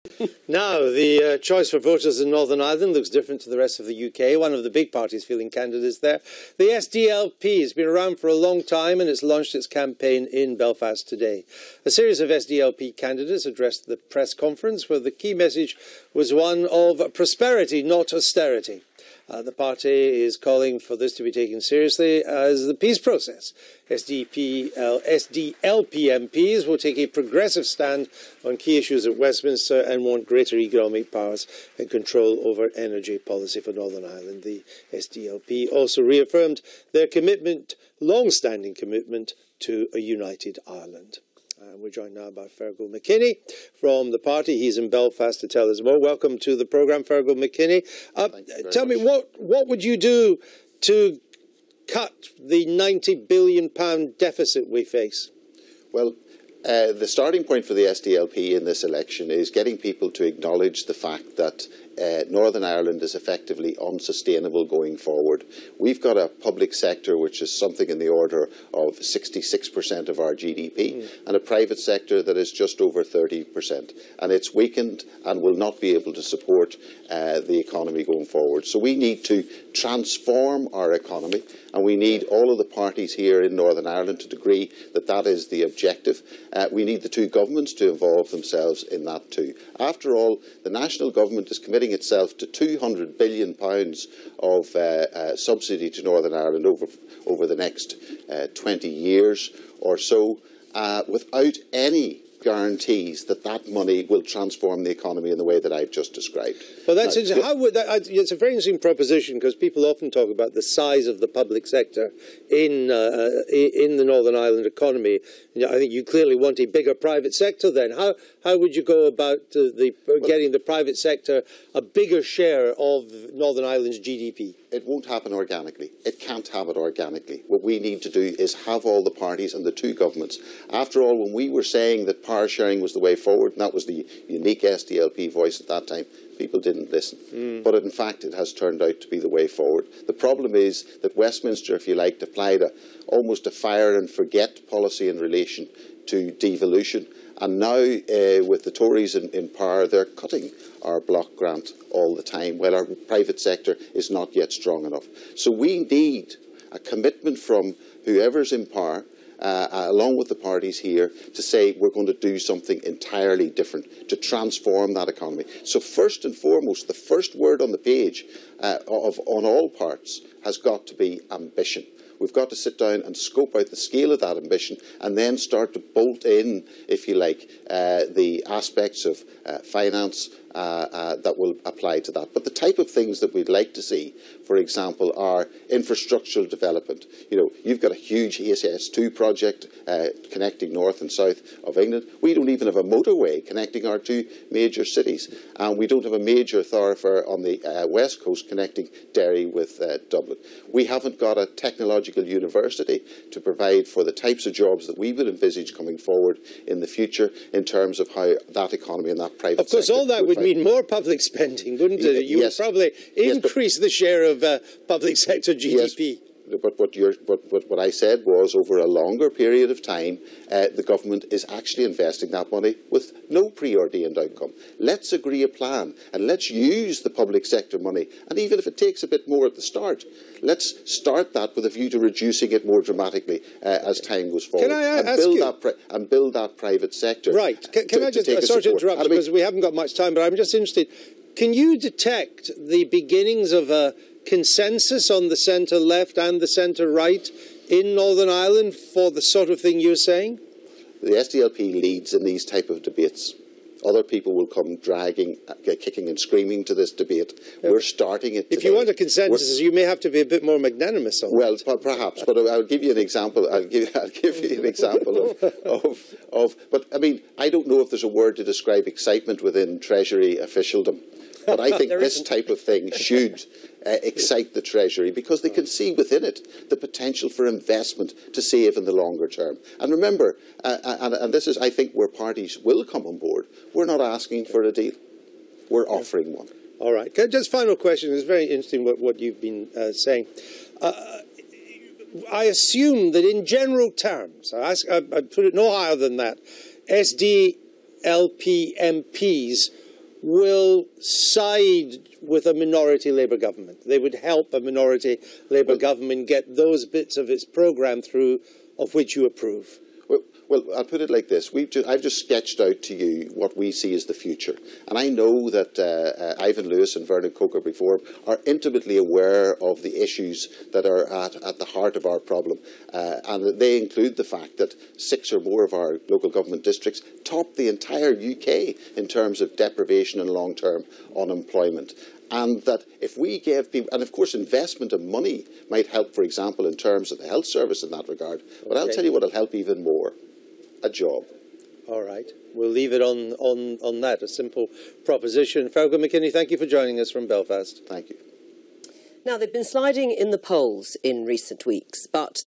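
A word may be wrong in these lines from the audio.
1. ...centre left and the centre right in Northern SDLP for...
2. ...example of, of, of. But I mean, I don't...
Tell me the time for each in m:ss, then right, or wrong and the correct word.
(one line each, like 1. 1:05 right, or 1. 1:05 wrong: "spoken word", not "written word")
1. 4:05 wrong: "Ireland", not "SDLP"
2. 4:24 right.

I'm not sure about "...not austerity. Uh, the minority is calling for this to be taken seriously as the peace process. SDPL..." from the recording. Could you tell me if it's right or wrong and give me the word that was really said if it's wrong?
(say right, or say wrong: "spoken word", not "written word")
wrong: "party", not "minority".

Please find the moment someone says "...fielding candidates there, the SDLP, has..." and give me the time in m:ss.
0:05.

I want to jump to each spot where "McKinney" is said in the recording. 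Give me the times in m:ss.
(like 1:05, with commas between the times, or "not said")
0:42, 0:47, 5:45.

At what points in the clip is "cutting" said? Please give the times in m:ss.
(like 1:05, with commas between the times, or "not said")
2:30.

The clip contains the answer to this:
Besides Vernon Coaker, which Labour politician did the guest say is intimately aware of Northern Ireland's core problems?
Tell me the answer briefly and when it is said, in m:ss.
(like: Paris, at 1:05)
Ivan Lewis, at 5:16.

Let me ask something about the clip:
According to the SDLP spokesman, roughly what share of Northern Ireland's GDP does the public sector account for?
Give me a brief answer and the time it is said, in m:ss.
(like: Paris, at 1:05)
66%, at 1:08.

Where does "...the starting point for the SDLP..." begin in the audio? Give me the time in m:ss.
0:56.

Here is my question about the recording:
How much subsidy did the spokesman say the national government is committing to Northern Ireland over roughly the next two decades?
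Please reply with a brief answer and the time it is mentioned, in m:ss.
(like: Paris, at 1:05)
£200 billion, at 1:32.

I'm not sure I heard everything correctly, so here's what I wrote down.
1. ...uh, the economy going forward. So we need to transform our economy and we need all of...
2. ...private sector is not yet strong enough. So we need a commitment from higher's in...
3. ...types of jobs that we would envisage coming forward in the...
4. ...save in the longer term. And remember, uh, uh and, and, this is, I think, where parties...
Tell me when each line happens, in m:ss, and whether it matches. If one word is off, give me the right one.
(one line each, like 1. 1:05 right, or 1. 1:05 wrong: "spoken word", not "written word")
1. 1:17 right
2. 2:33 wrong: "whoever", not "higher"
3. 3:24 right
4. 4:38 right.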